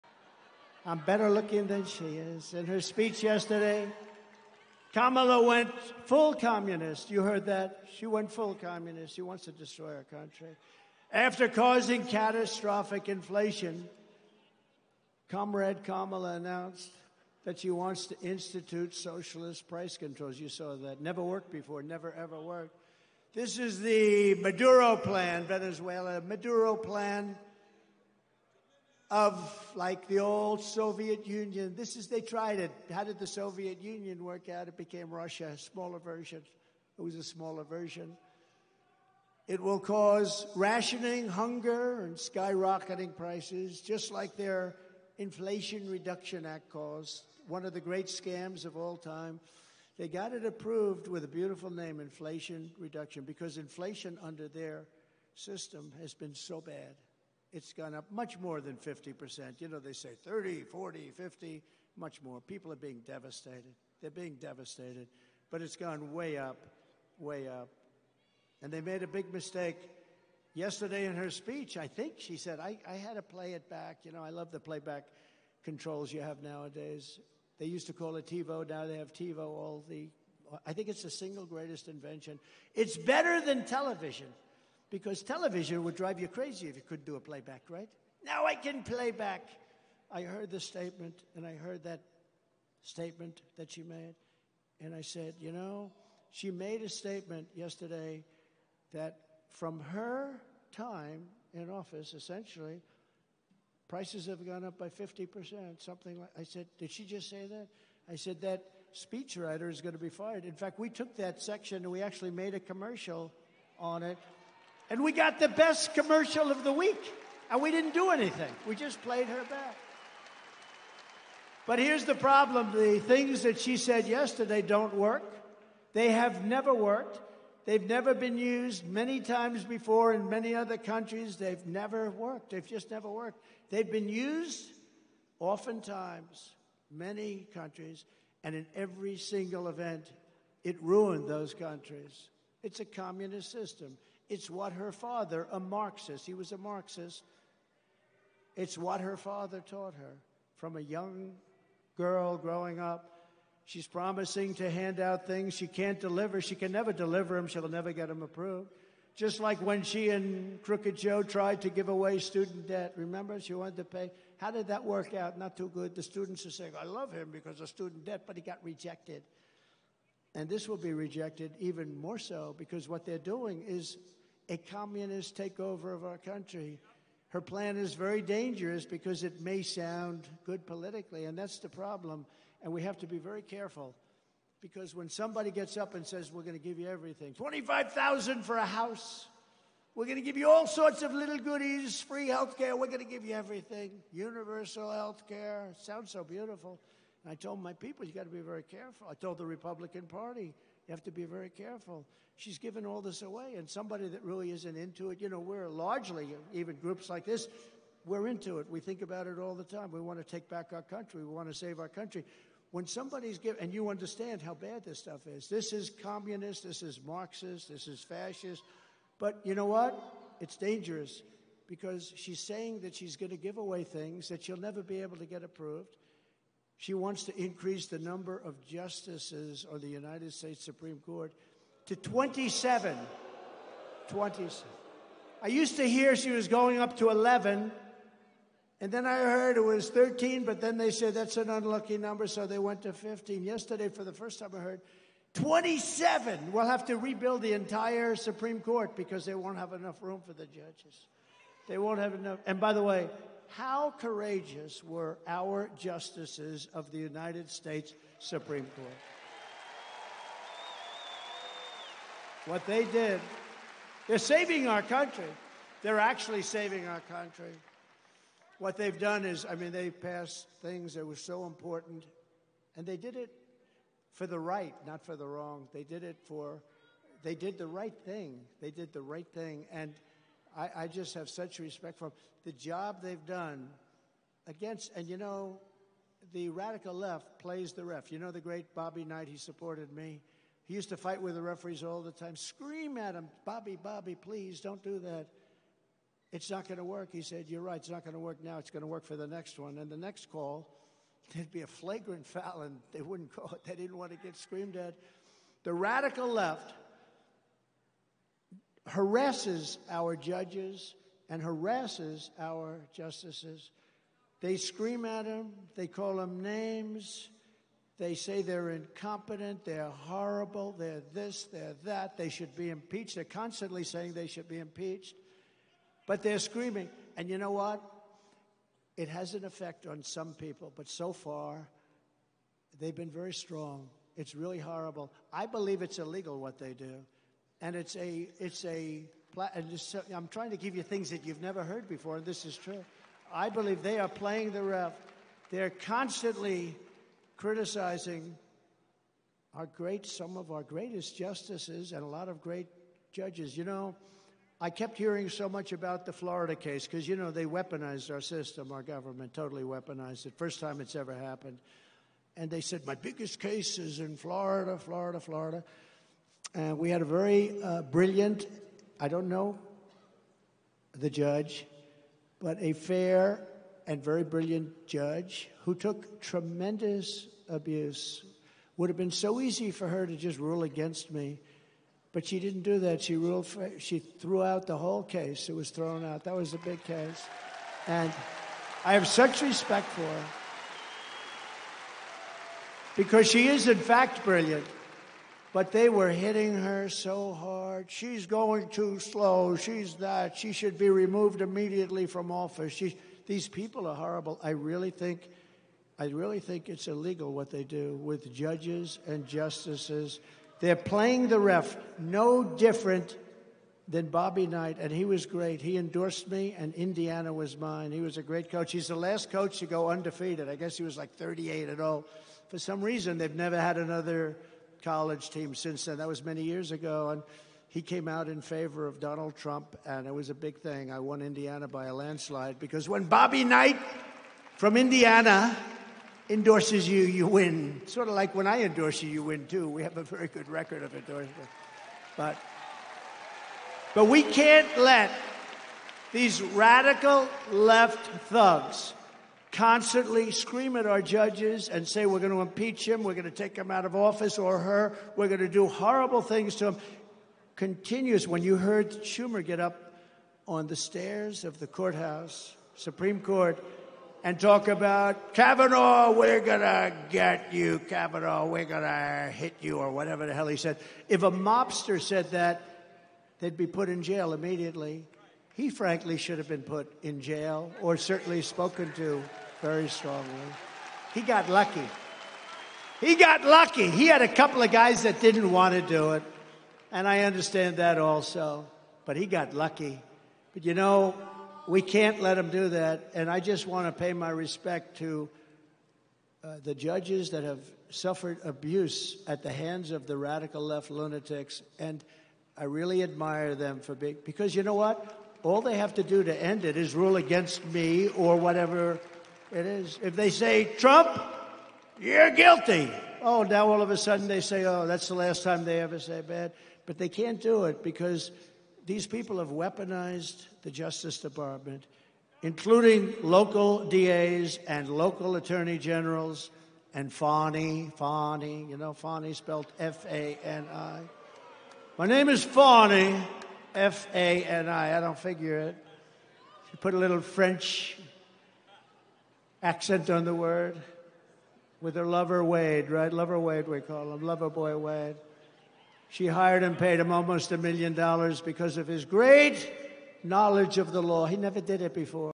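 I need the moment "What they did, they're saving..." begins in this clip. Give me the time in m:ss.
4:22.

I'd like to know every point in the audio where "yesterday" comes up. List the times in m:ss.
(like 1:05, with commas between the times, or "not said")
0:03, 1:10, 1:37, 2:04, 4:03.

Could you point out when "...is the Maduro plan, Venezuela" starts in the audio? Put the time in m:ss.
0:23.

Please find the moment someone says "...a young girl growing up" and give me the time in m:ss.
2:30.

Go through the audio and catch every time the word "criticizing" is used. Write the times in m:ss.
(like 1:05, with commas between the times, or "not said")
5:47.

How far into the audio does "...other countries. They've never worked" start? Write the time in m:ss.
2:10.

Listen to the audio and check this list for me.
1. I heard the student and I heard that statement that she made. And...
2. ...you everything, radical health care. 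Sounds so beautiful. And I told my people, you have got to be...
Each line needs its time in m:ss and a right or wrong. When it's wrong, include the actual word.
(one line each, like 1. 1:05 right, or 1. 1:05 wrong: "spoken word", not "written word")
1. 1:30 wrong: "statement", not "student"
2. 3:13 wrong: "universal", not "radical".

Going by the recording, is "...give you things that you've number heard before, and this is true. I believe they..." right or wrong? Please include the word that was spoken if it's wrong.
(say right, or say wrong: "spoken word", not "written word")
wrong: "never", not "number".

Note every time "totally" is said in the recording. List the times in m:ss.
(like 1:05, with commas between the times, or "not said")
5:59.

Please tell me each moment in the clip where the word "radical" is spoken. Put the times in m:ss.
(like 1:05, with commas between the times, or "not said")
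4:46, 5:05, 7:26, 8:20.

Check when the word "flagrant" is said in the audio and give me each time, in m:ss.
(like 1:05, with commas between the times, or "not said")
5:01.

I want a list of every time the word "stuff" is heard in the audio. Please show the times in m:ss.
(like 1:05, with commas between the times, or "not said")
3:34.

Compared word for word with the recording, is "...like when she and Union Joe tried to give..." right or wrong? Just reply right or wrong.
wrong.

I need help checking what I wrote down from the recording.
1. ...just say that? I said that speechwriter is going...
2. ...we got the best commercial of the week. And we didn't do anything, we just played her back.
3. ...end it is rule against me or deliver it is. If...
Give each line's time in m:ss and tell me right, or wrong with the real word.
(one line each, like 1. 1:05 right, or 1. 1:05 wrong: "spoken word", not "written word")
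1. 1:47 right
2. 1:55 right
3. 8:26 wrong: "whatever", not "deliver".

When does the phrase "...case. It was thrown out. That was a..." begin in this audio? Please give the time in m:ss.
6:25.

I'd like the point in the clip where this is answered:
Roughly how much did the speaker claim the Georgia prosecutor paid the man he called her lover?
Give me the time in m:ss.
9:07.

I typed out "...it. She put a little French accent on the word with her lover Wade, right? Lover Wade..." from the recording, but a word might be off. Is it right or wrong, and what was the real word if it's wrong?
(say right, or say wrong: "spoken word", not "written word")
right.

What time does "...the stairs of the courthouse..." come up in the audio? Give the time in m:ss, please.
7:40.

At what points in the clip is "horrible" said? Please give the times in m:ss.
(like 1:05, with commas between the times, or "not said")
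5:19, 5:34, 6:43, 7:35.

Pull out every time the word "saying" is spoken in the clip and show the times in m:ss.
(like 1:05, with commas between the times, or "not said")
2:46, 3:42, 5:23.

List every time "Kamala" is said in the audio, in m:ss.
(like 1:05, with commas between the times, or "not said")
0:04, 0:15.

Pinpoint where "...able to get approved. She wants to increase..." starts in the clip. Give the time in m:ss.
3:45.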